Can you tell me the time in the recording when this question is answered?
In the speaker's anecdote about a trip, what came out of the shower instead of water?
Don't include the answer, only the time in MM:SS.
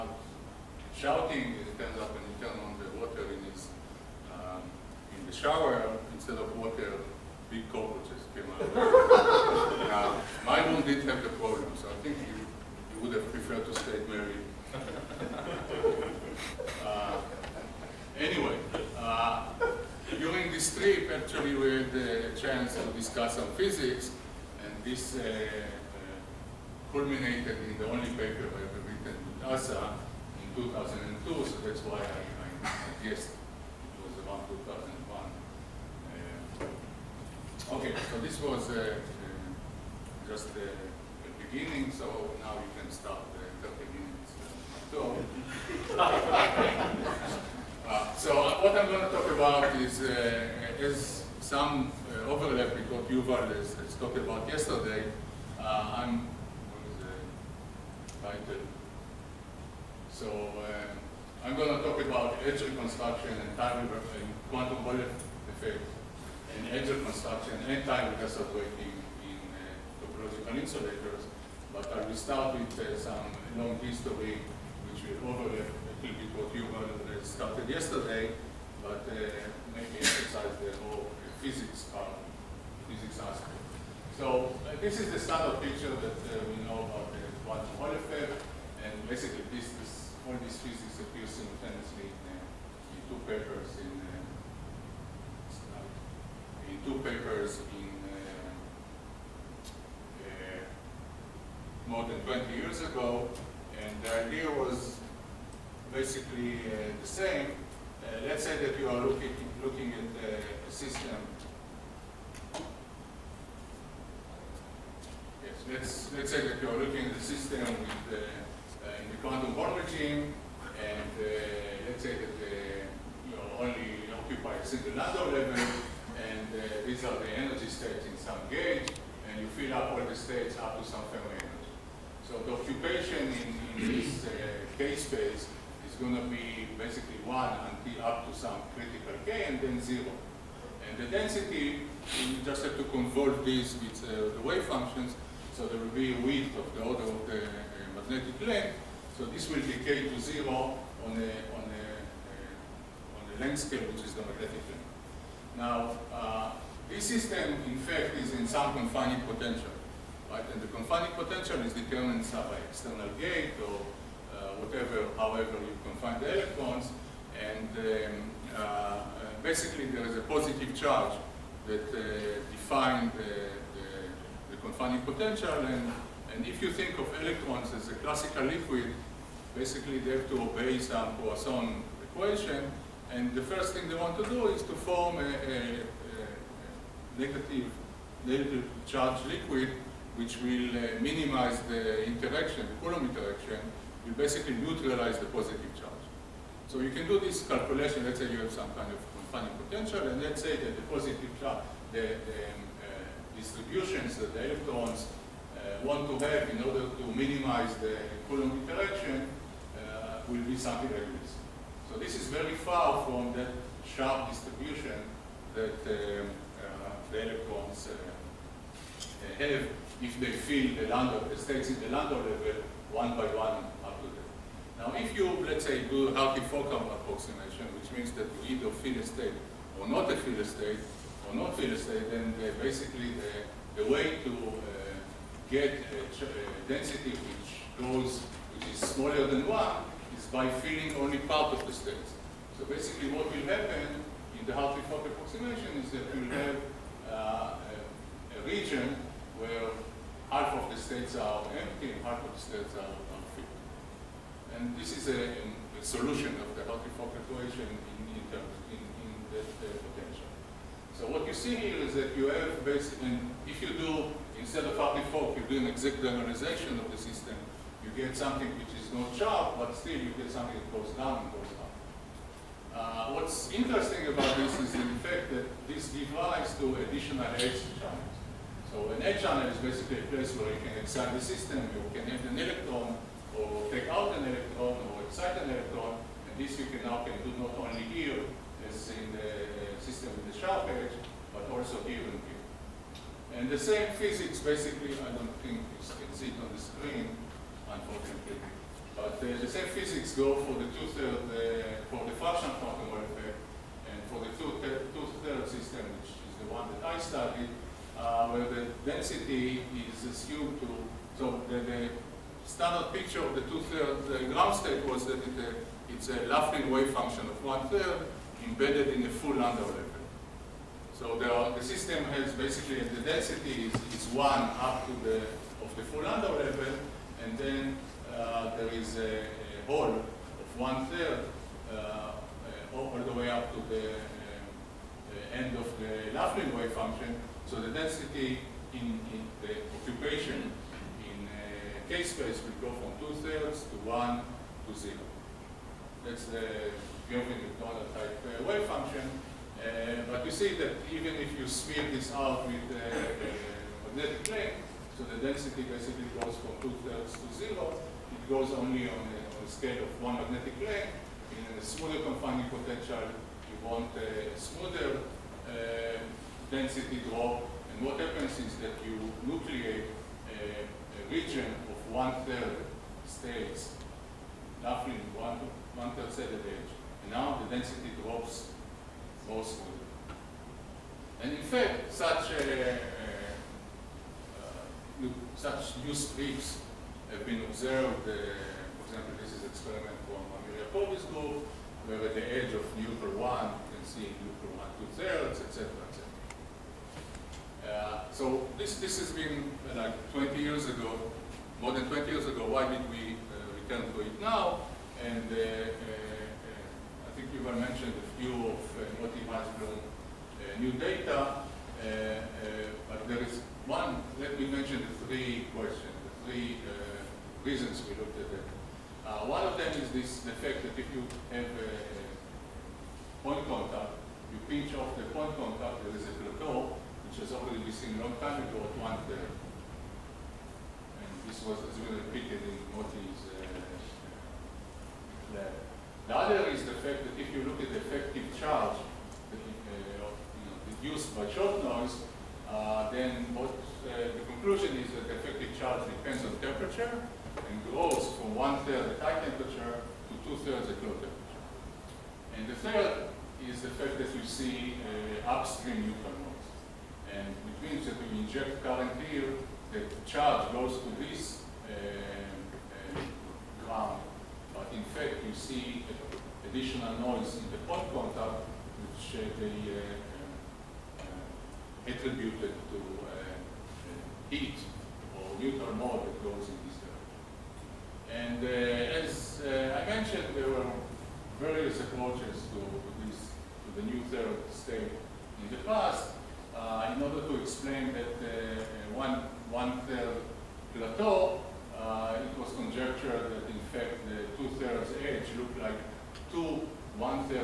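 00:07.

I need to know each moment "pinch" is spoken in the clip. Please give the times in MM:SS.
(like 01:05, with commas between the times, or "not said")
07:04.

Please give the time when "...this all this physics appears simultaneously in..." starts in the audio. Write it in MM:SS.
01:29.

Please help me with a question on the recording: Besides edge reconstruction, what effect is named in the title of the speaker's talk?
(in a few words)
time quantum bullet effect.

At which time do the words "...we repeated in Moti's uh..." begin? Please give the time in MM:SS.
07:11.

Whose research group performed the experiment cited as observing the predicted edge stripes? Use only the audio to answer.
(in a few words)
Amelia Povey's.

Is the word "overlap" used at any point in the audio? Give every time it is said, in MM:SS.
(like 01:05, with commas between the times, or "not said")
00:52, 01:15.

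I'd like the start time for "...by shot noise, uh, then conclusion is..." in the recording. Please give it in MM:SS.
07:21.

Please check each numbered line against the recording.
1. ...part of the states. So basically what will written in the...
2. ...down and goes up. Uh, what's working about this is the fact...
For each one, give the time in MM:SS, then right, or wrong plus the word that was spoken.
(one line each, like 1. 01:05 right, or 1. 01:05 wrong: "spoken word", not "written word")
1. 04:01 wrong: "happen", not "written"
2. 04:30 wrong: "interesting", not "working".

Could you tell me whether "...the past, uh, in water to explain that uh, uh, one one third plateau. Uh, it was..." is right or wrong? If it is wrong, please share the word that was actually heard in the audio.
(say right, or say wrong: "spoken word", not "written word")
wrong: "order", not "water".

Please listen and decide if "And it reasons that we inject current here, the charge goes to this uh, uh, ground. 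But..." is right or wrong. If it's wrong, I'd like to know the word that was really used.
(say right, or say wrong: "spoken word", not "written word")
wrong: "means", not "reasons".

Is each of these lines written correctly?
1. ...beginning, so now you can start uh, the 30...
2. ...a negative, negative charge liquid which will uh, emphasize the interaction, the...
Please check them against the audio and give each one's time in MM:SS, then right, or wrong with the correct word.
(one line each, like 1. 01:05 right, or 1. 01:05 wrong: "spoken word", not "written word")
1. 00:41 right
2. 03:05 wrong: "minimize", not "emphasize".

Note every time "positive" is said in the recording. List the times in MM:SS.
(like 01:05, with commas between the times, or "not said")
02:50, 03:15, 03:20.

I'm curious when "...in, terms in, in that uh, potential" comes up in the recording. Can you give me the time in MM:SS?
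04:18.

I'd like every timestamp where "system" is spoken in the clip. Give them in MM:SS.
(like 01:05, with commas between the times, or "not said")
01:50, 01:57, 02:37, 04:26, 04:41, 04:49, 05:05, 05:21.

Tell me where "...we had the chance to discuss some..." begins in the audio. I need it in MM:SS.
00:21.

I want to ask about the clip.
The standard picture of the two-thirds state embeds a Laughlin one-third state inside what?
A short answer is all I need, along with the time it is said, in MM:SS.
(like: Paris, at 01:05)
a full Landau level, at 05:19.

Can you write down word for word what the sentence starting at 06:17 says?
And now the density drops more smoothly.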